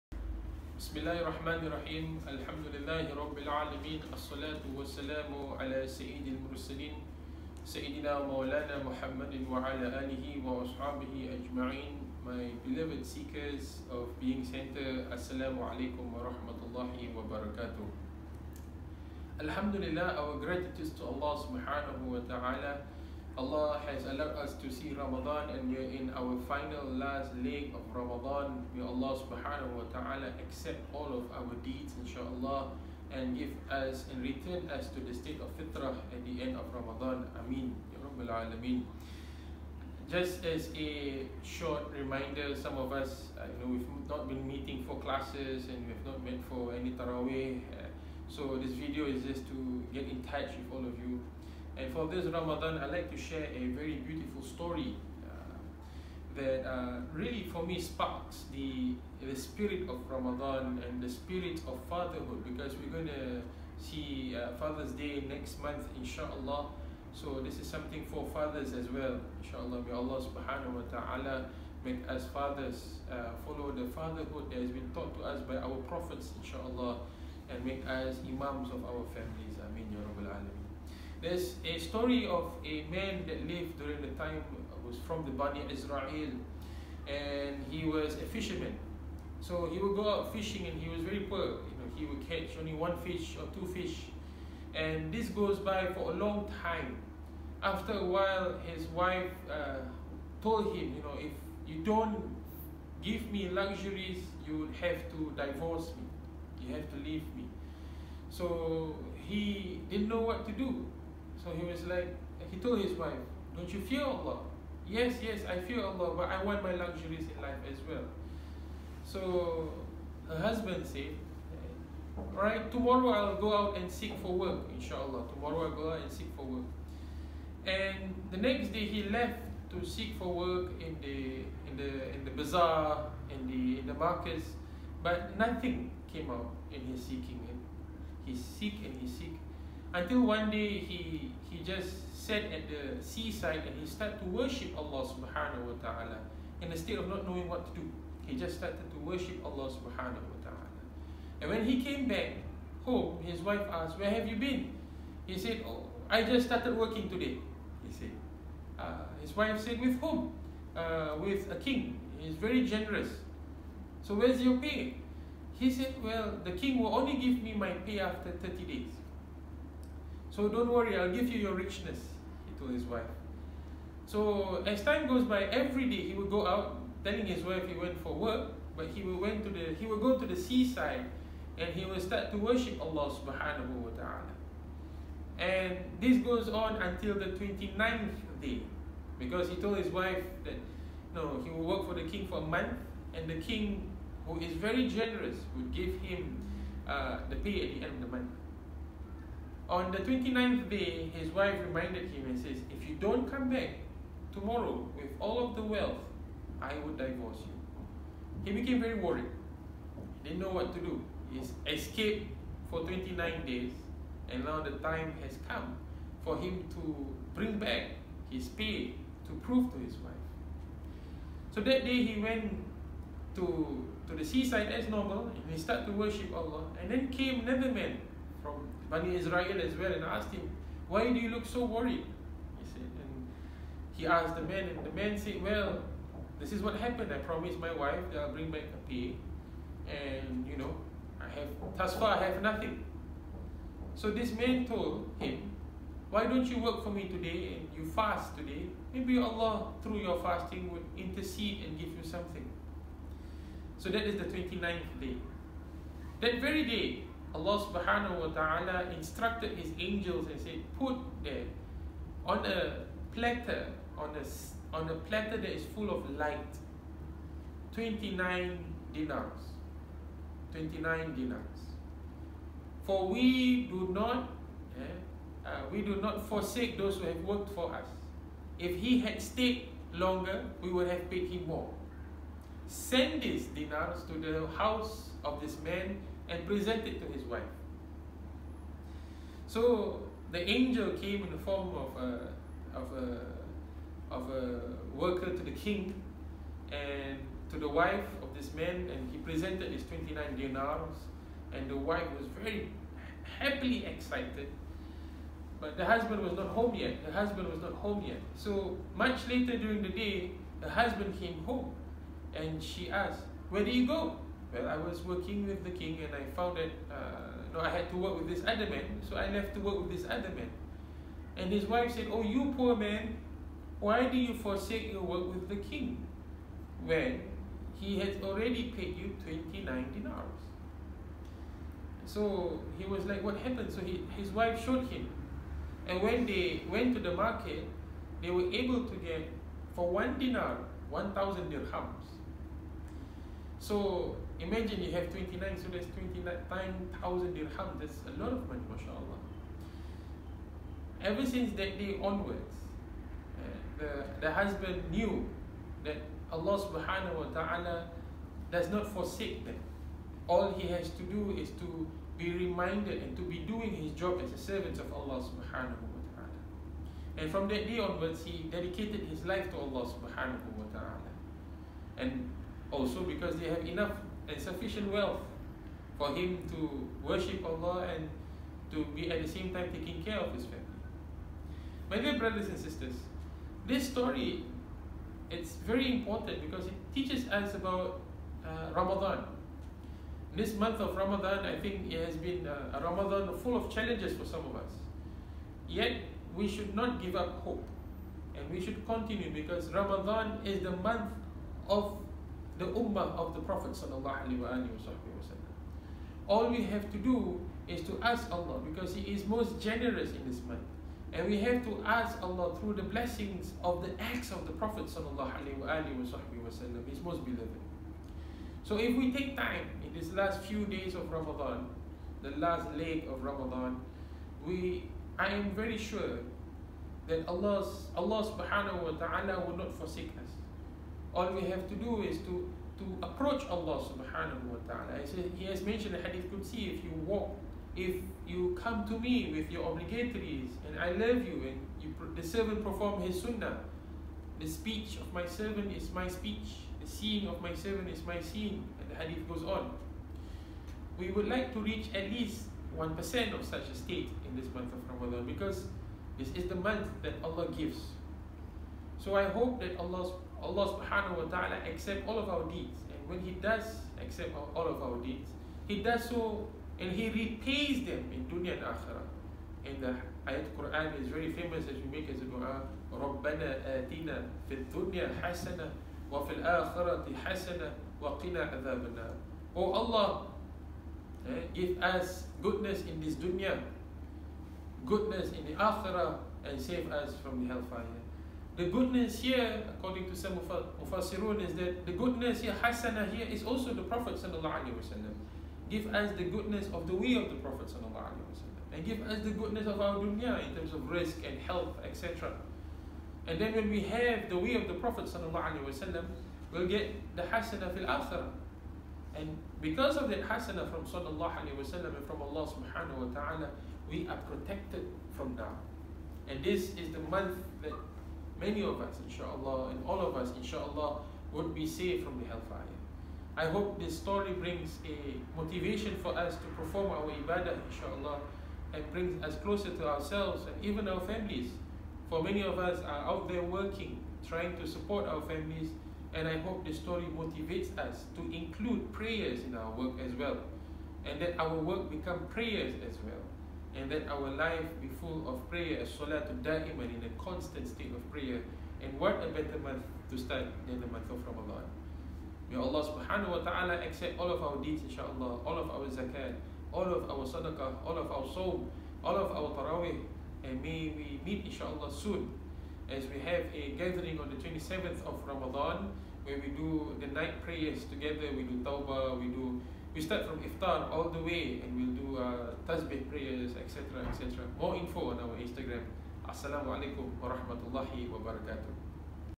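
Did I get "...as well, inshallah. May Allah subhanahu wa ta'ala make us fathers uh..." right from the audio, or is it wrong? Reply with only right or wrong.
right.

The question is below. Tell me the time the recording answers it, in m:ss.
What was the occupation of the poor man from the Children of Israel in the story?
1:28.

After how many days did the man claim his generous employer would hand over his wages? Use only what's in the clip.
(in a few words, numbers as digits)
30.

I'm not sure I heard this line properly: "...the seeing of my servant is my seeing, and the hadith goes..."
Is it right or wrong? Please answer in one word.
right.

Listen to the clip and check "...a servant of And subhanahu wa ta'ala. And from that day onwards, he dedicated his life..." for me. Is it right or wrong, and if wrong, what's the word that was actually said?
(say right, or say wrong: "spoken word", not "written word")
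wrong: "Allah", not "And".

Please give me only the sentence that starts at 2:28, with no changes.
He just started to worship Allah subhanahu wa ta'ala.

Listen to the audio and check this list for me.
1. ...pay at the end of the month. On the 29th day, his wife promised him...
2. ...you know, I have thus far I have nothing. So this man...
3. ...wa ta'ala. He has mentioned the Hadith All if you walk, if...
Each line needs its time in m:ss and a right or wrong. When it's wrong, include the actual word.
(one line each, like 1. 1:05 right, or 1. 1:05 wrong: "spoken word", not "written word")
1. 3:17 wrong: "reminded", not "promised"
2. 4:00 right
3. 7:14 wrong: "Qudsi", not "All".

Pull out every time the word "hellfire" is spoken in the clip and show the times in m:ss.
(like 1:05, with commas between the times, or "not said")
8:07, 8:42.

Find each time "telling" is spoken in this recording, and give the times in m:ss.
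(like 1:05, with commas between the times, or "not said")
2:57.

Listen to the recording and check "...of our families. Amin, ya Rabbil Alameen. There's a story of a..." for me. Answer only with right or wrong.
right.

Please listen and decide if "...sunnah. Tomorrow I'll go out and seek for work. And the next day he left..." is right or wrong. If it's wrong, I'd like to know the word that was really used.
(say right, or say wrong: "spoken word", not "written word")
wrong: "inshallah", not "sunnah".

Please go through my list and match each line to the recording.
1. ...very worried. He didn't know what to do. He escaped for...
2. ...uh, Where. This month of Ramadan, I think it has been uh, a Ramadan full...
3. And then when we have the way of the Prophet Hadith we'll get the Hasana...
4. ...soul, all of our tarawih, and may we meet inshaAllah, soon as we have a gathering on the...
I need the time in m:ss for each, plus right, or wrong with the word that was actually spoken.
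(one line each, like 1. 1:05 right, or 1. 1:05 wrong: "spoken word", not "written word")
1. 3:28 right
2. 6:28 wrong: "Ramadan", not "Where"
3. 8:23 wrong: "Sallallahu", not "Hadith"
4. 9:18 right.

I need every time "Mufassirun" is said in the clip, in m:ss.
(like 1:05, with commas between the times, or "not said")
8:10.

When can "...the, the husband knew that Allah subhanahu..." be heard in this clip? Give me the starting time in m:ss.
5:53.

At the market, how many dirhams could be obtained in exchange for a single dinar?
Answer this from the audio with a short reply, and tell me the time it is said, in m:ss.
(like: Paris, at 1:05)
1,000, at 5:40.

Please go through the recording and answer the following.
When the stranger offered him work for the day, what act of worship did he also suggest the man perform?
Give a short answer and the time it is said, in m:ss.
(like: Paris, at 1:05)
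Fasting, at 4:07.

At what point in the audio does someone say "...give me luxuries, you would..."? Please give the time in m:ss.
1:43.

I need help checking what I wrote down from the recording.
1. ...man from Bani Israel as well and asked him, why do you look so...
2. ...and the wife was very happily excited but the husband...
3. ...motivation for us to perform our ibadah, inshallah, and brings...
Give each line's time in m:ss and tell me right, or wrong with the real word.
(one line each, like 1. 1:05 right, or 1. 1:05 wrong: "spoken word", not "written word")
1. 3:47 right
2. 5:01 right
3. 8:45 right.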